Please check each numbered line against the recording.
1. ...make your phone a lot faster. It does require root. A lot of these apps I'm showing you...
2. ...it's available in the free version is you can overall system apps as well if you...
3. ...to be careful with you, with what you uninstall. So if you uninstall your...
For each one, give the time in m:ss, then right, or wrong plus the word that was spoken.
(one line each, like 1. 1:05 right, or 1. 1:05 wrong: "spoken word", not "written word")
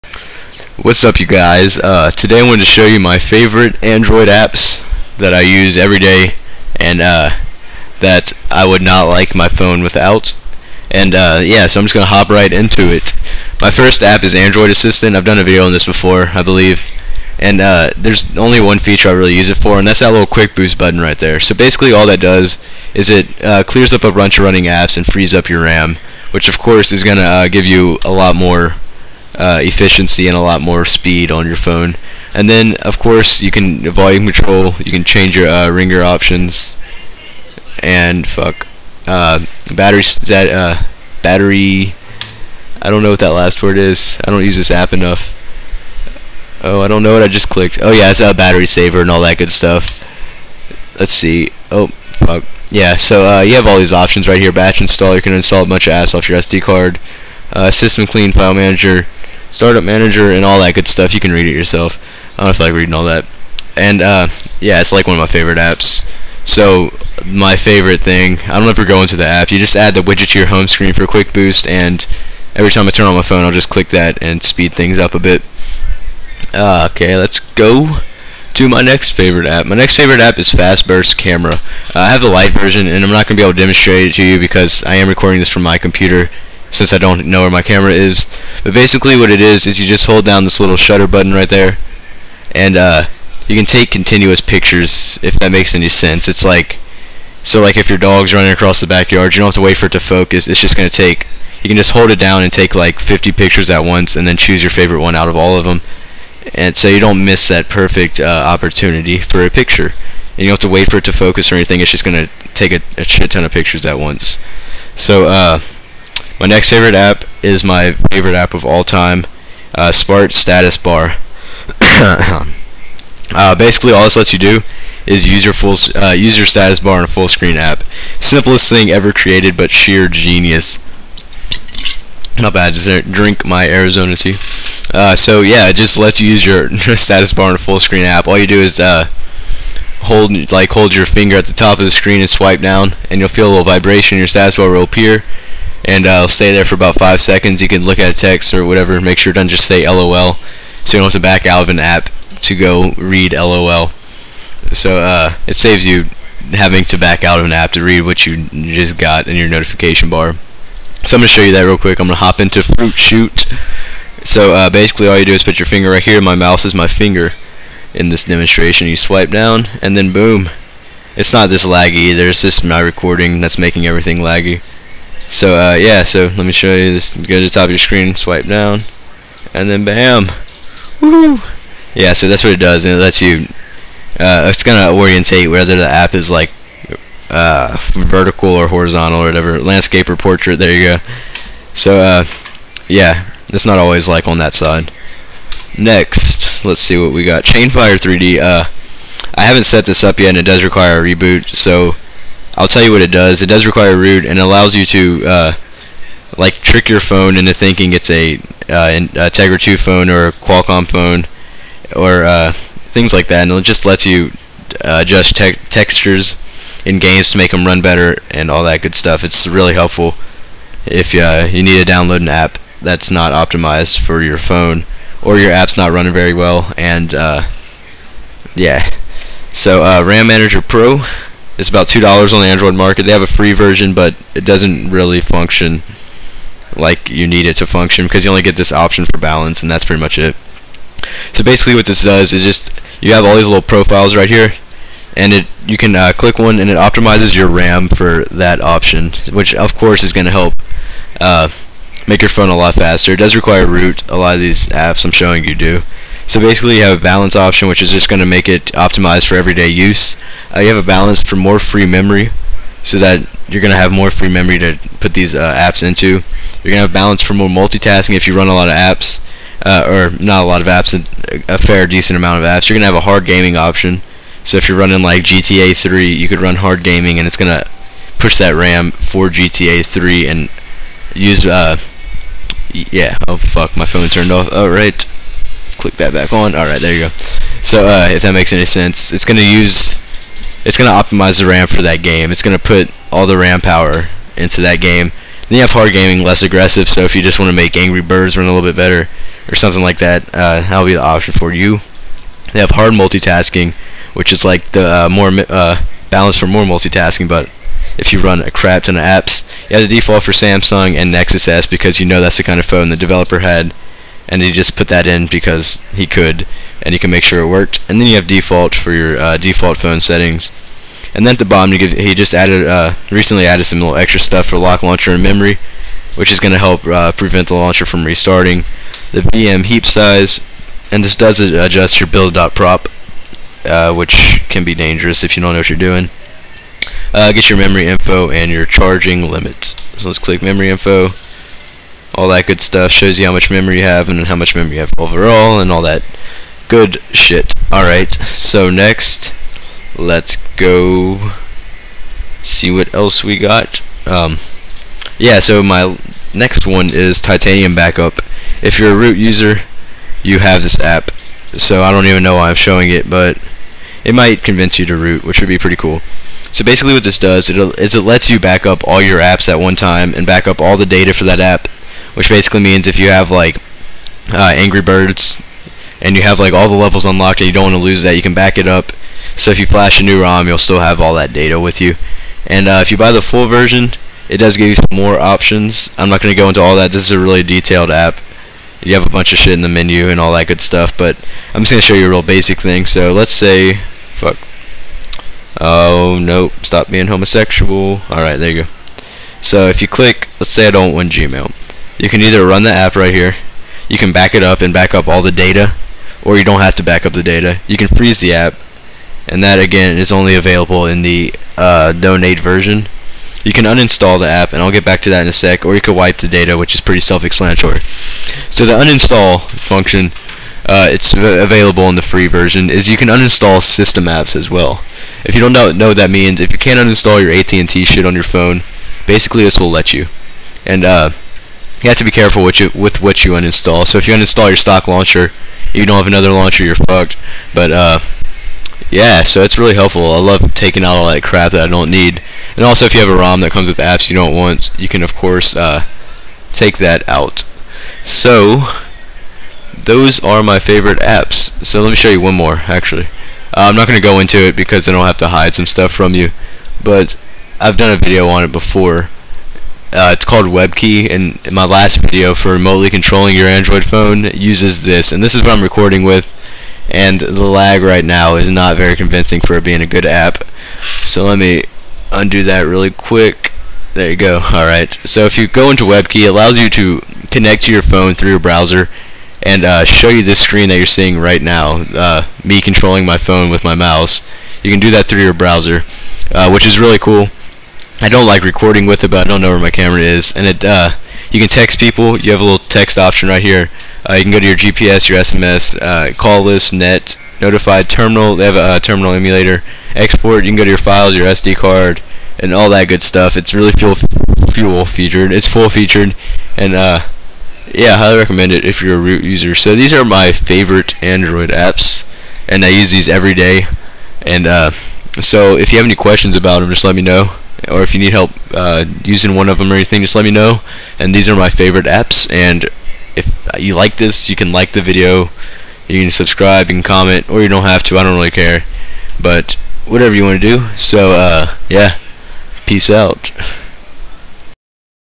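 1. 4:12 right
2. 7:00 wrong: "uninstall", not "overall"
3. 7:11 right.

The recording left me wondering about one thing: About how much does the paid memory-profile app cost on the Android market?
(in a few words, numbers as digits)
2 dollars.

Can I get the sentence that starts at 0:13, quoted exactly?
My first app is Android Assistant.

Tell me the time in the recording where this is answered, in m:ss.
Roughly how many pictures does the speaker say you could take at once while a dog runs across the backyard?
1:42.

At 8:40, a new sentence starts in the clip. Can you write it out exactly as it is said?
And these are my favorite apps.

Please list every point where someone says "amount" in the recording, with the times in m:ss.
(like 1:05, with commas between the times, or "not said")
4:32.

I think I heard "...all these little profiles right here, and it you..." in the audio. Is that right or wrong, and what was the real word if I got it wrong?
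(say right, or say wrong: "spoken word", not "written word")
right.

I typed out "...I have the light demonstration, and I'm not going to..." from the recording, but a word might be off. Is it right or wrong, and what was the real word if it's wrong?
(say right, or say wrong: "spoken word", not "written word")
wrong: "version", not "demonstration".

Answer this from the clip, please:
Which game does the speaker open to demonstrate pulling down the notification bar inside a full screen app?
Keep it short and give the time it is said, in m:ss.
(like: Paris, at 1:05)
Fruit Shoot, at 2:42.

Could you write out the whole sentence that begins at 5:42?
Shows you how much memory you have and how much memory you have overall and all that good shit.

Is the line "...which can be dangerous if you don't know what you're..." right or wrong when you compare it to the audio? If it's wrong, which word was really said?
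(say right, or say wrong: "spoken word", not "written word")
right.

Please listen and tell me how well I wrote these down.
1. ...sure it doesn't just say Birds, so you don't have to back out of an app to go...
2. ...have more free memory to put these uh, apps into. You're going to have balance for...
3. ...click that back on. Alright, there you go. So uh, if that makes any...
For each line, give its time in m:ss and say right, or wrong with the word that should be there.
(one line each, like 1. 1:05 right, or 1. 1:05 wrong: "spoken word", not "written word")
1. 2:29 wrong: "LOL", not "Birds"
2. 4:23 right
3. 4:45 right.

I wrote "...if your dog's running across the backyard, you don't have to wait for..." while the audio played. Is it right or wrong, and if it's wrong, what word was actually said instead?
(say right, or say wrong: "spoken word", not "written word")
right.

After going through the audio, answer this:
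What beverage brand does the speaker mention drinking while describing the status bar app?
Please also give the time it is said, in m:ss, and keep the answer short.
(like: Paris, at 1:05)
Arizona tea, at 2:13.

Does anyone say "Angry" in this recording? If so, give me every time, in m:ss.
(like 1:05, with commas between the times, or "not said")
4:57, 6:14.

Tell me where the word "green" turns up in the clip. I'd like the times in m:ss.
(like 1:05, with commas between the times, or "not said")
not said.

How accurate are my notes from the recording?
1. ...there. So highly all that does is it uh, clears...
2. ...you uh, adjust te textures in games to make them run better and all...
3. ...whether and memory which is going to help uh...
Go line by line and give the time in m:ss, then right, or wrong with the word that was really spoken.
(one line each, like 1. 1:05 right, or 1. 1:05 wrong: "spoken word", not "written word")
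1. 0:21 wrong: "basically", not "highly"
2. 3:34 right
3. 5:24 wrong: "launcher", not "whether".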